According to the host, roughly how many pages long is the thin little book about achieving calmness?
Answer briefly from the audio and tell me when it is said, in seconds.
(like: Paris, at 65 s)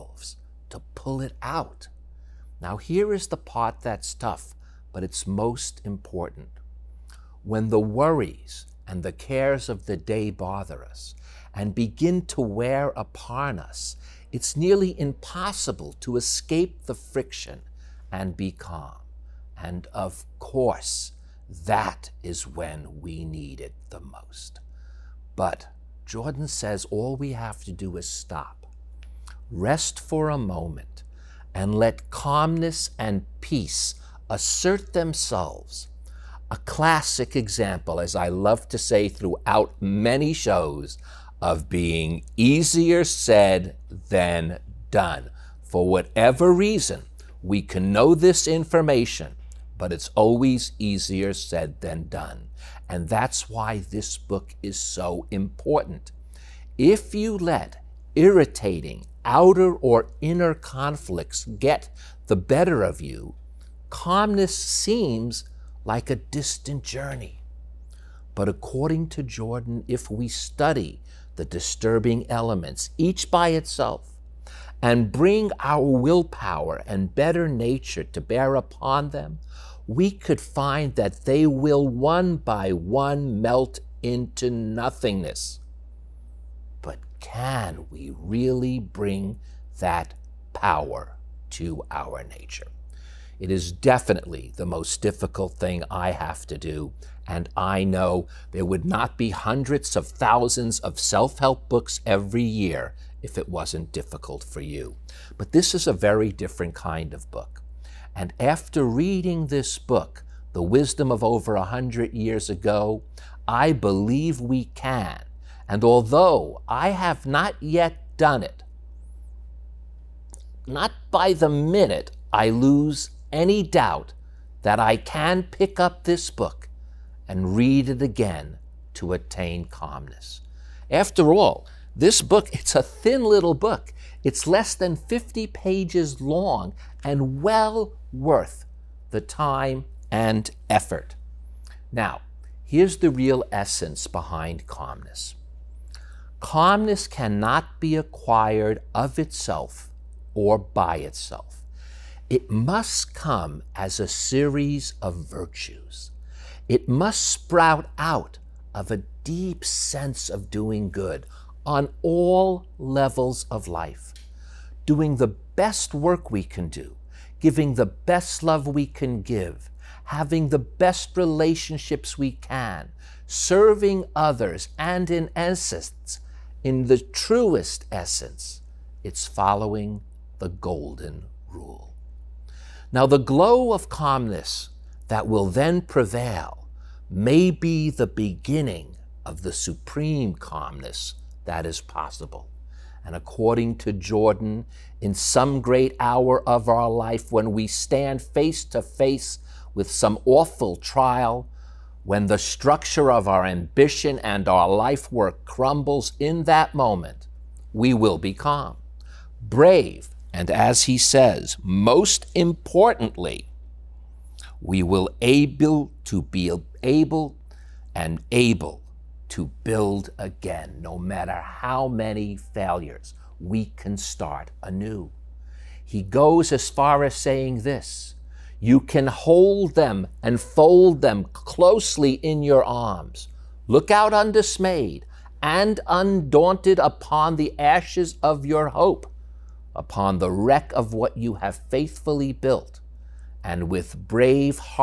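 less than 50, at 134 s.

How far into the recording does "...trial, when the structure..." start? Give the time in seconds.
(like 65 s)
200 s.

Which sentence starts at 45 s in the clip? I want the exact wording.
For whatever reason, we can know this information but it's always easier said than done.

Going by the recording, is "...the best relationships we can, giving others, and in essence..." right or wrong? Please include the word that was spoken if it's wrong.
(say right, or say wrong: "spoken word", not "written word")
wrong: "serving", not "giving".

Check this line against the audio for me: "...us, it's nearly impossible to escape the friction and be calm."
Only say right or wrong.
right.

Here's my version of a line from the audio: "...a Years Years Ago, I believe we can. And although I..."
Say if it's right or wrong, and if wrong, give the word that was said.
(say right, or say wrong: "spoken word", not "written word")
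wrong: "Hundred", not "Years".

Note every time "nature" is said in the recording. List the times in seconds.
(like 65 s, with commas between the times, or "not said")
77 s, 92 s.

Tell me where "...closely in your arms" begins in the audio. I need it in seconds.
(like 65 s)
231 s.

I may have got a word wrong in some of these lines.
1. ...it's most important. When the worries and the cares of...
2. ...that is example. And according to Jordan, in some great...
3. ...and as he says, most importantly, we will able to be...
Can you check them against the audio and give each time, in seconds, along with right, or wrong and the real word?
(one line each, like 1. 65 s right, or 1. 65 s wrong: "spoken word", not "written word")
1. 5 s right
2. 191 s wrong: "possible", not "example"
3. 210 s right.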